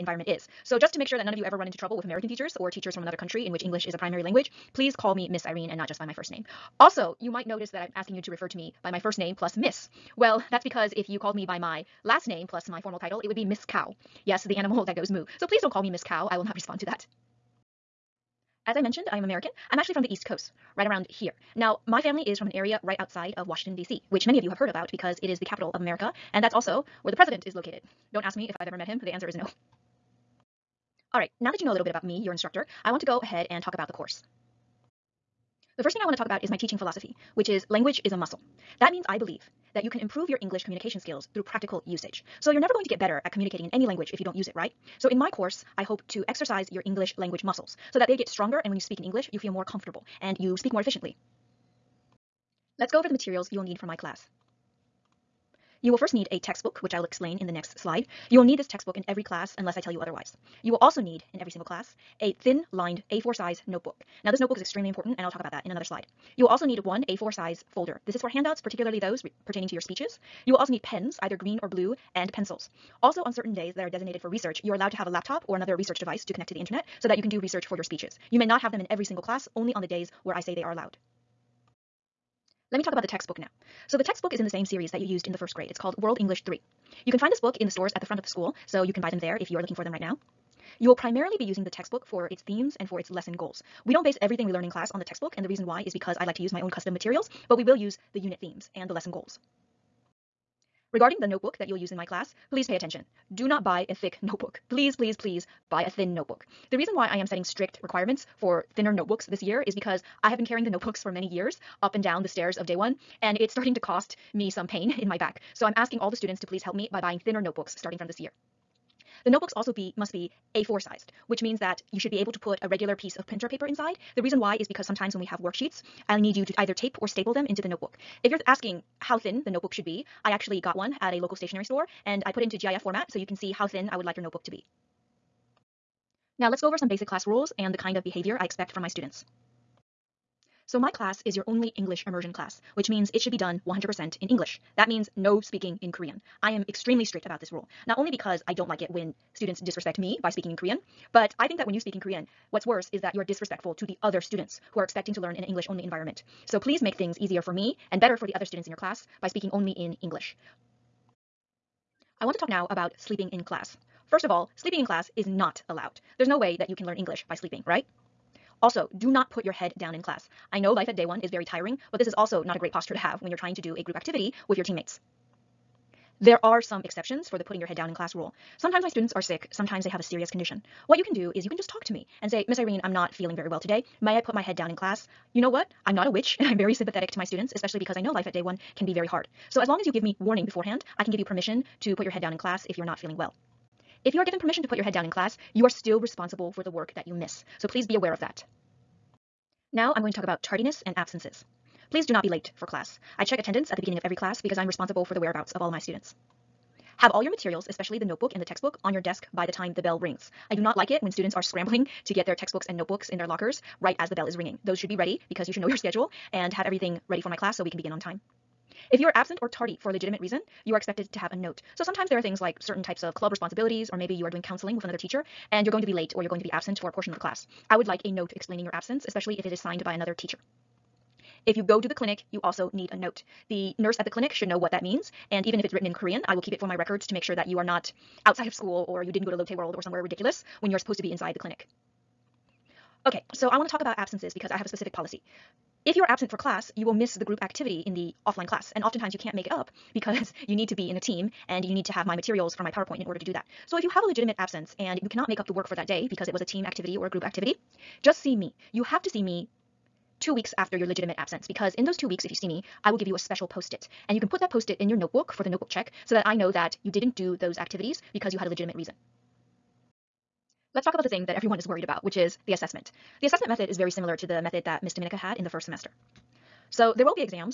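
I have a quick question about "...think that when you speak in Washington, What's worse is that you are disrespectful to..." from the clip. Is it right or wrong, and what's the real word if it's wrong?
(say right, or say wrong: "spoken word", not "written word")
wrong: "Korean", not "Washington".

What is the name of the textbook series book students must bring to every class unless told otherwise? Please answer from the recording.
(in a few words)
World English 3.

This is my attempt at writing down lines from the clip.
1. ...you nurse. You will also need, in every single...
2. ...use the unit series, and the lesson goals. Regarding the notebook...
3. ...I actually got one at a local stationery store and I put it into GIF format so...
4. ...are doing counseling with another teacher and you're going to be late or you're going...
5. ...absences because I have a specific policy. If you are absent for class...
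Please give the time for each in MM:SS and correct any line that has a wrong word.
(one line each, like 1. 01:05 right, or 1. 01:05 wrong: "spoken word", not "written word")
1. 00:59 wrong: "otherwise", not "nurse"
2. 01:37 wrong: "themes", not "series"
3. 02:10 right
4. 03:44 right
5. 04:03 right.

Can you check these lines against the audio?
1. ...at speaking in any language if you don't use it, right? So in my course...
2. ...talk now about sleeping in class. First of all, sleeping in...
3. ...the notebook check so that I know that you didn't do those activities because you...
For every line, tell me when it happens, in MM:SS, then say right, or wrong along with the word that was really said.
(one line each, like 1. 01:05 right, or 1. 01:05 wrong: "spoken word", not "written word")
1. 00:43 wrong: "communicating", not "speaking"
2. 02:42 right
3. 04:25 right.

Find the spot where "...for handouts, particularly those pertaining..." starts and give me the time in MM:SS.
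01:08.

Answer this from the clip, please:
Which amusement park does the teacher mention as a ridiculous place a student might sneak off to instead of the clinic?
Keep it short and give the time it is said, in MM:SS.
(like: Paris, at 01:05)
Lotte World, at 03:59.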